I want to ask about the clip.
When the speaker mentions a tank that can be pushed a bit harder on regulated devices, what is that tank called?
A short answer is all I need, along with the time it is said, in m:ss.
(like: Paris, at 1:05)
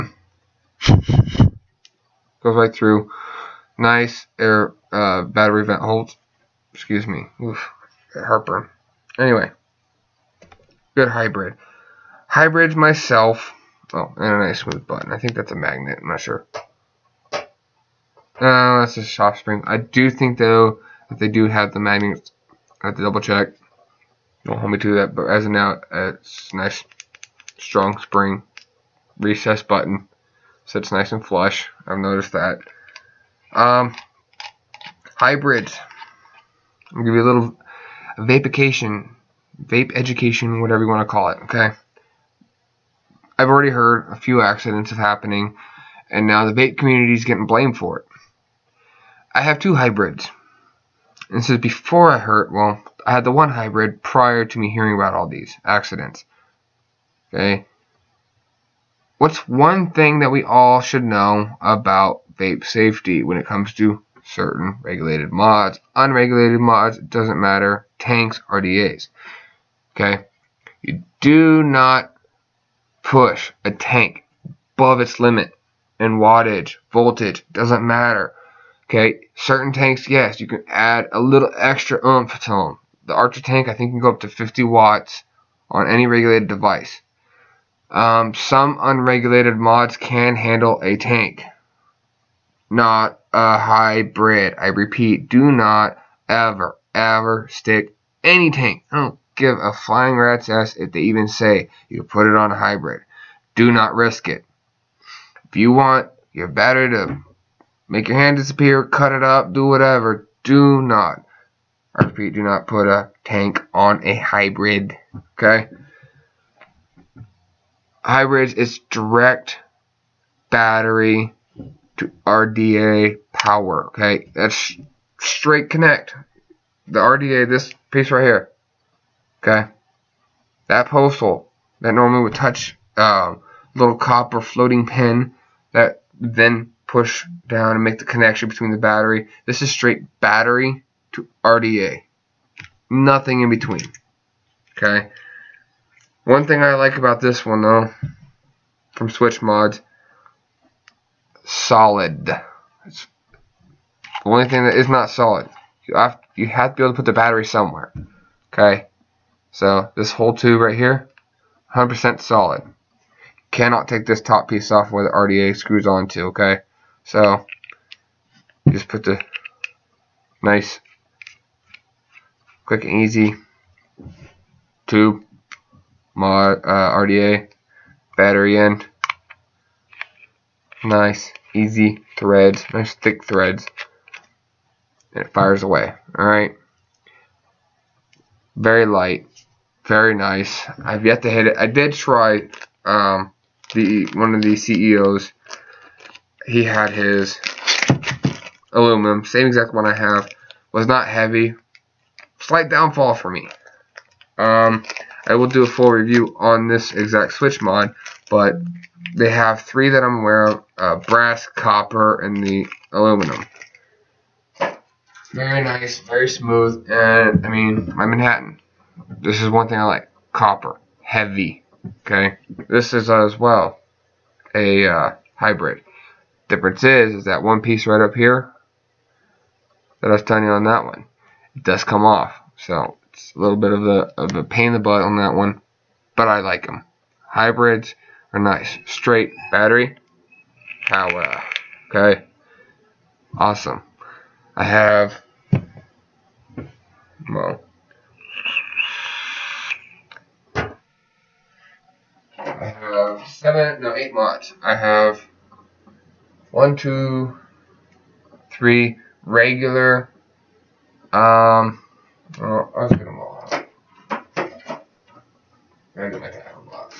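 Archer, at 1:23.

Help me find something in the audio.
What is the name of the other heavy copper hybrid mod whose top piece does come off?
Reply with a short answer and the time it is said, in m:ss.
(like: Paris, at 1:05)
Manhattan, at 3:38.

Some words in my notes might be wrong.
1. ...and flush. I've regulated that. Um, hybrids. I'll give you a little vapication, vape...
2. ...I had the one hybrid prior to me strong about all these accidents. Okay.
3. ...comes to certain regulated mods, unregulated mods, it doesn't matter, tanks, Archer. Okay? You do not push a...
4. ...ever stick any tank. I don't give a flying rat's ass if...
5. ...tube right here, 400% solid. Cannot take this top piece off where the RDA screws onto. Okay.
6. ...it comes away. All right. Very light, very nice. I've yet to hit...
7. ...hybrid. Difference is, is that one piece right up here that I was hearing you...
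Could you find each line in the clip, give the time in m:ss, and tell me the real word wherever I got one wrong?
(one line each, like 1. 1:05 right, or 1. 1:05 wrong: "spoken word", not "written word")
1. 0:31 wrong: "noticed", not "regulated"
2. 0:53 wrong: "hearing", not "strong"
3. 1:03 wrong: "RDAs", not "Archer"
4. 1:36 right
5. 2:40 wrong: "100", not "400"
6. 3:05 wrong: "fires", not "comes"
7. 3:45 wrong: "telling", not "hearing".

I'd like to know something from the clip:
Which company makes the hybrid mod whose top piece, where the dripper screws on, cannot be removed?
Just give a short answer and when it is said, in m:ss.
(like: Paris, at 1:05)
Switch Mods, at 2:29.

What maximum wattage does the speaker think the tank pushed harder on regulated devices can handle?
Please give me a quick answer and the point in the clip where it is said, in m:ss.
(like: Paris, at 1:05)
50 watts, at 1:24.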